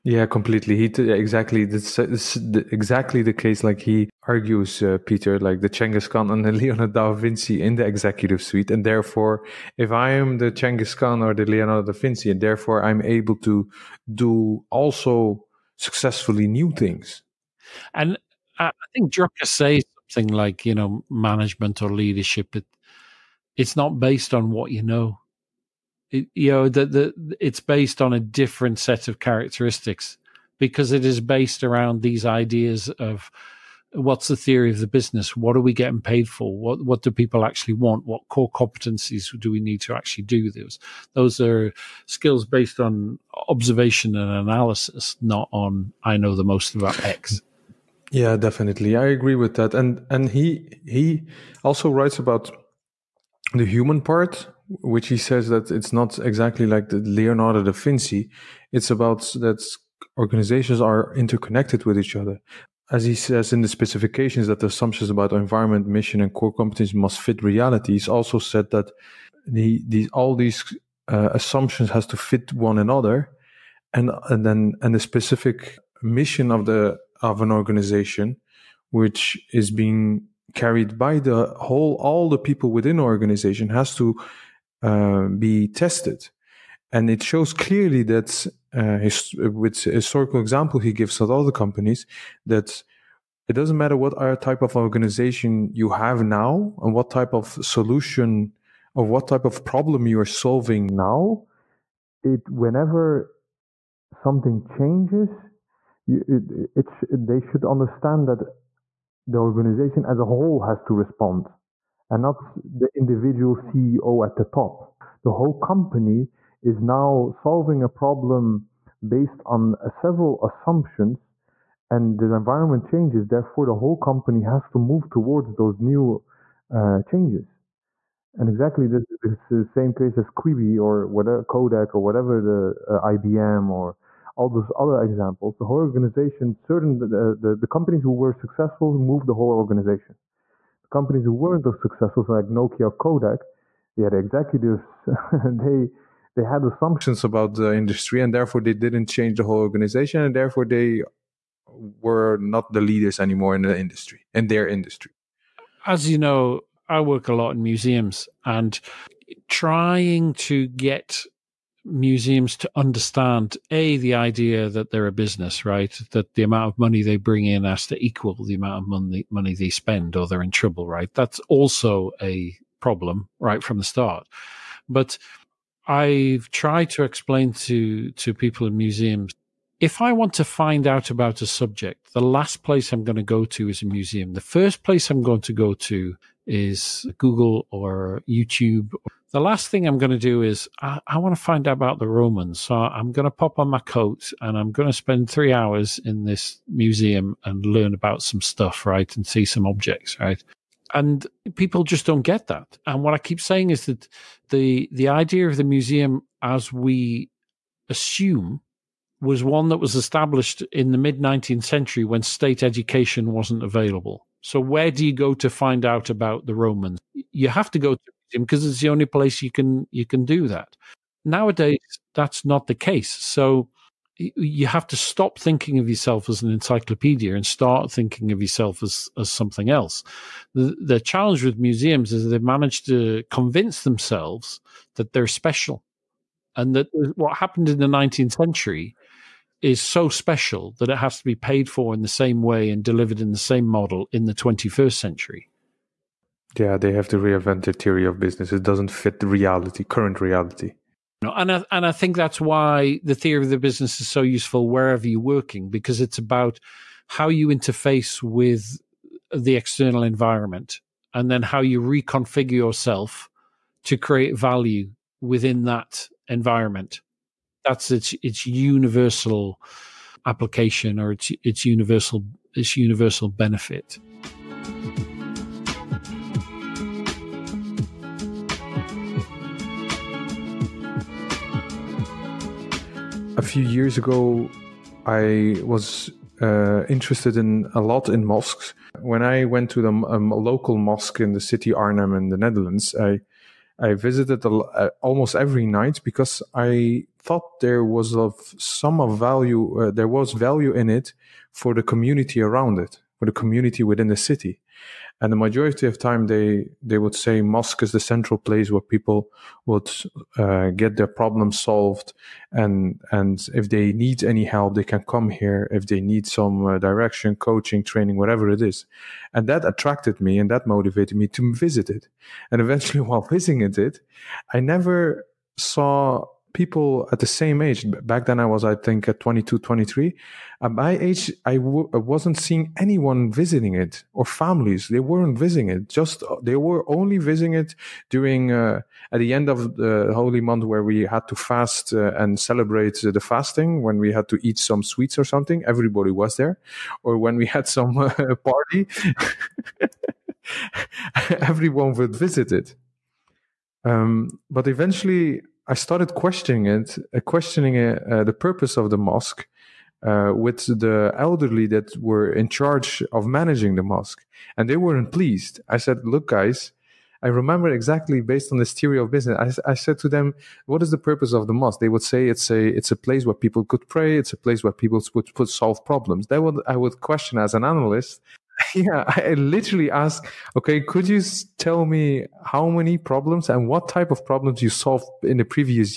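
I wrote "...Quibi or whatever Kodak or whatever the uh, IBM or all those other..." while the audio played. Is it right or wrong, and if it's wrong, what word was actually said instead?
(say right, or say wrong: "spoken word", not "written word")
right.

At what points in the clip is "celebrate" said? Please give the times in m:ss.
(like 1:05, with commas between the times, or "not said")
5:42.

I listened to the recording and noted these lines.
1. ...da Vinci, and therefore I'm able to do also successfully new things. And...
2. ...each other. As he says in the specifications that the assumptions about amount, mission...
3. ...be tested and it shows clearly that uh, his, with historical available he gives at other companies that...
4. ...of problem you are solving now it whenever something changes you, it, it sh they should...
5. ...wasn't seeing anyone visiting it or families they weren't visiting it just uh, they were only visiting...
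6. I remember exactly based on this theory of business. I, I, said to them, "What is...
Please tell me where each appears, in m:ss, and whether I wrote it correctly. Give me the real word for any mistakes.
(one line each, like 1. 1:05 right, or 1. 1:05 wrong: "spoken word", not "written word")
1. 0:11 right
2. 1:01 wrong: "environment", not "amount"
3. 1:25 wrong: "example", not "available"
4. 1:39 right
5. 5:31 right
6. 6:07 right.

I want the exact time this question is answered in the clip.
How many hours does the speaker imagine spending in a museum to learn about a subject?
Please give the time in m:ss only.
3:15.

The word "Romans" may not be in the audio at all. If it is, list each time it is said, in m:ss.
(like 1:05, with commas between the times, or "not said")
3:12, 3:36.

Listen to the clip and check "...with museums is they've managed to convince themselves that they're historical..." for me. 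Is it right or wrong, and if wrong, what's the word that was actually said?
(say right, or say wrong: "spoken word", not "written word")
wrong: "special", not "historical".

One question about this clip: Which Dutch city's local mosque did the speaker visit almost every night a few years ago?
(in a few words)
Arnhem.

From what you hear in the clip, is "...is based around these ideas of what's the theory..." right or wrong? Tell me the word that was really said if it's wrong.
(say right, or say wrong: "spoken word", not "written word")
right.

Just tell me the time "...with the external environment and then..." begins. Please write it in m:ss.
4:18.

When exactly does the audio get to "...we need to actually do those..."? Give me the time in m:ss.
0:39.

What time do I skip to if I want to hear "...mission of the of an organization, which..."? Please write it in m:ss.
1:16.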